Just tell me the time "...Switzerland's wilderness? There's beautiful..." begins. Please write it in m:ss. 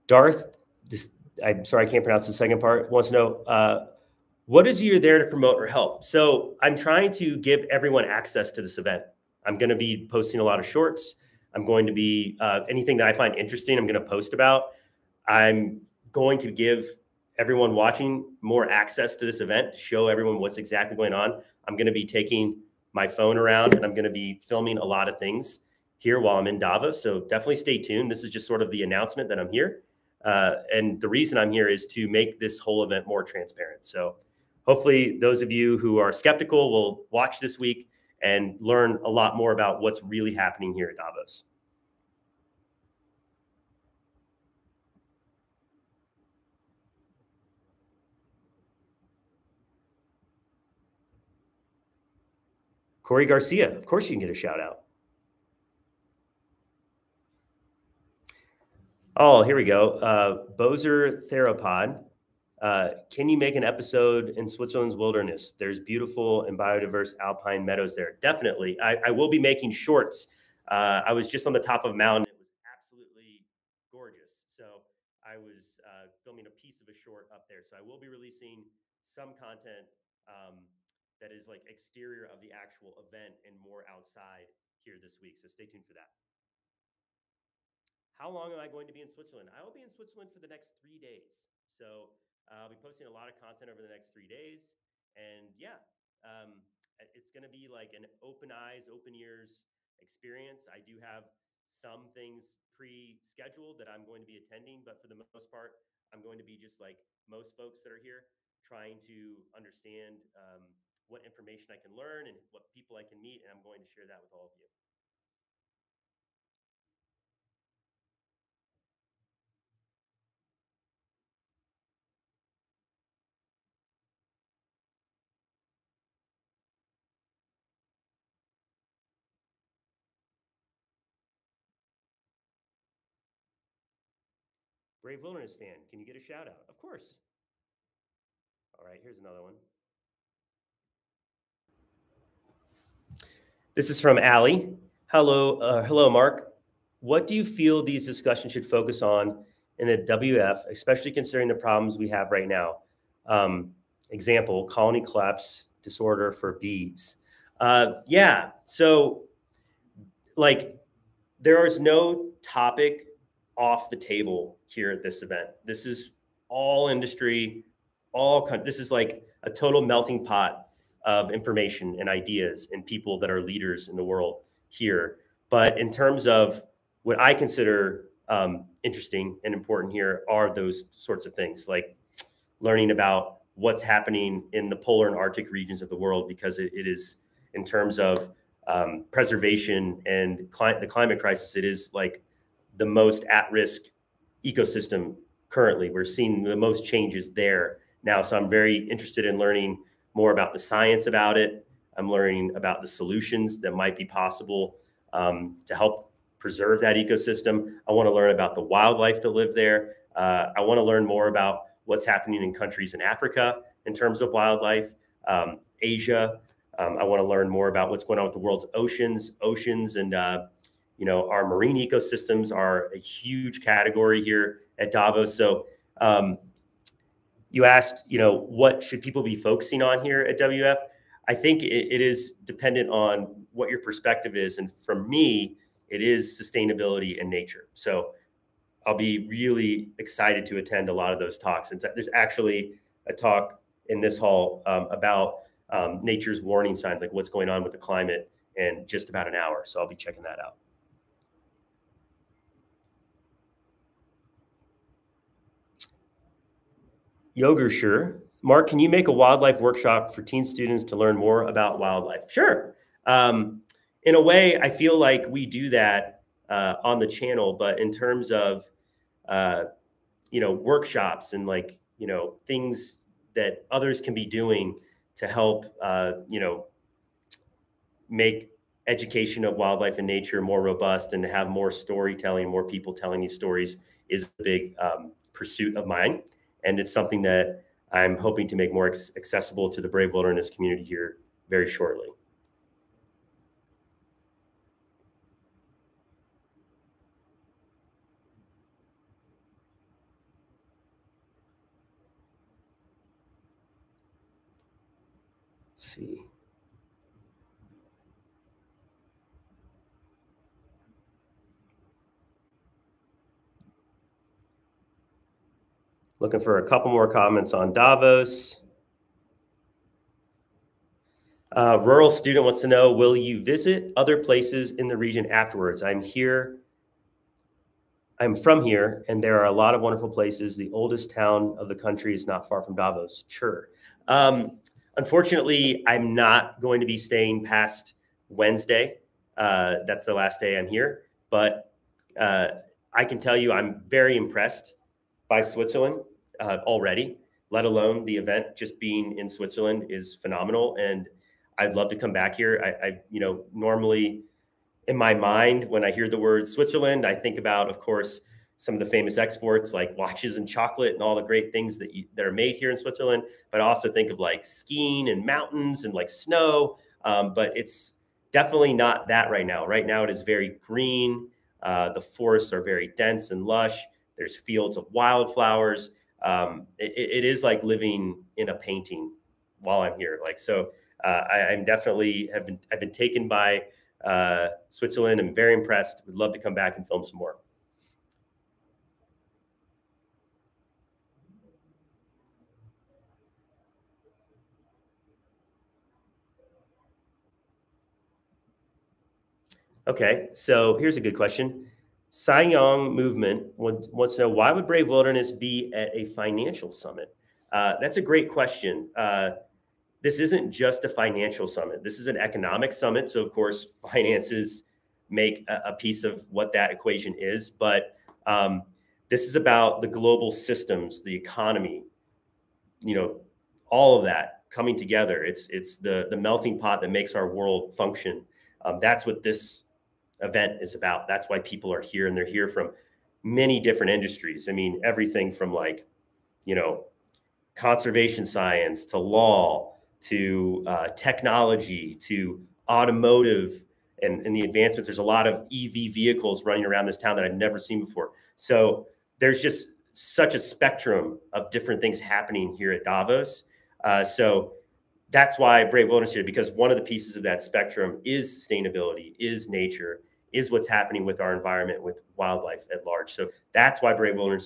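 1:04.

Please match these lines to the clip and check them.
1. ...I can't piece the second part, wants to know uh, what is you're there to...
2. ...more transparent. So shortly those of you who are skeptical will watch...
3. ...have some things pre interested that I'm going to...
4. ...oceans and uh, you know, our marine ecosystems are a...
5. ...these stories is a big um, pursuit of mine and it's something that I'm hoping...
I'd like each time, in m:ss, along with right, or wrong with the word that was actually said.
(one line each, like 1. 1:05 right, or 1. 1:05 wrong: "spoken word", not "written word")
1. 0:01 wrong: "pronounce", not "piece"
2. 0:33 wrong: "hopefully", not "shortly"
3. 1:40 wrong: "scheduled", not "interested"
4. 3:39 right
5. 4:43 right.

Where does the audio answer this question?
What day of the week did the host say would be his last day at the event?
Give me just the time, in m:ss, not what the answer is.
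5:38.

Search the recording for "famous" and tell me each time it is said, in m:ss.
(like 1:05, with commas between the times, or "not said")
5:58.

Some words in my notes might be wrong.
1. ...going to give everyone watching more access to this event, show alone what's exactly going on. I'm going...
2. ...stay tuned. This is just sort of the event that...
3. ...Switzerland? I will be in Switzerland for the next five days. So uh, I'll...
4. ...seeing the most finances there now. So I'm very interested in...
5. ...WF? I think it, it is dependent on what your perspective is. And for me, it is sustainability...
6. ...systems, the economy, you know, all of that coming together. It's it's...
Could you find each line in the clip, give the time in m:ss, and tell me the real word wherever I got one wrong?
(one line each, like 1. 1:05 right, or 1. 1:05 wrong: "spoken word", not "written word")
1. 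0:16 wrong: "everyone", not "alone"
2. 0:27 wrong: "announcement", not "event"
3. 1:29 wrong: "three", not "five"
4. 3:16 wrong: "changes", not "finances"
5. 3:50 right
6. 7:00 right.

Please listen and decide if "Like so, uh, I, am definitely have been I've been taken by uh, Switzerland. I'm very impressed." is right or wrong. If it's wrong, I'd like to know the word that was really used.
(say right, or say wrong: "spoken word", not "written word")
right.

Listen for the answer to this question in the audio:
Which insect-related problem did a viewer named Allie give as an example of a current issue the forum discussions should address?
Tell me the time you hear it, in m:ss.
2:34.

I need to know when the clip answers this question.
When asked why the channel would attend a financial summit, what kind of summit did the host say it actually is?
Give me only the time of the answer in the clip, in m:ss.
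6:52.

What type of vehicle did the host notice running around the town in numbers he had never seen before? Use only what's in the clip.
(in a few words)
EV vehicles.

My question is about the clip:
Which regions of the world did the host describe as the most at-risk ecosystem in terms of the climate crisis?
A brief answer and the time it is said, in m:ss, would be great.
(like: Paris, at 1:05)
Polar and Arctic regions, at 3:04.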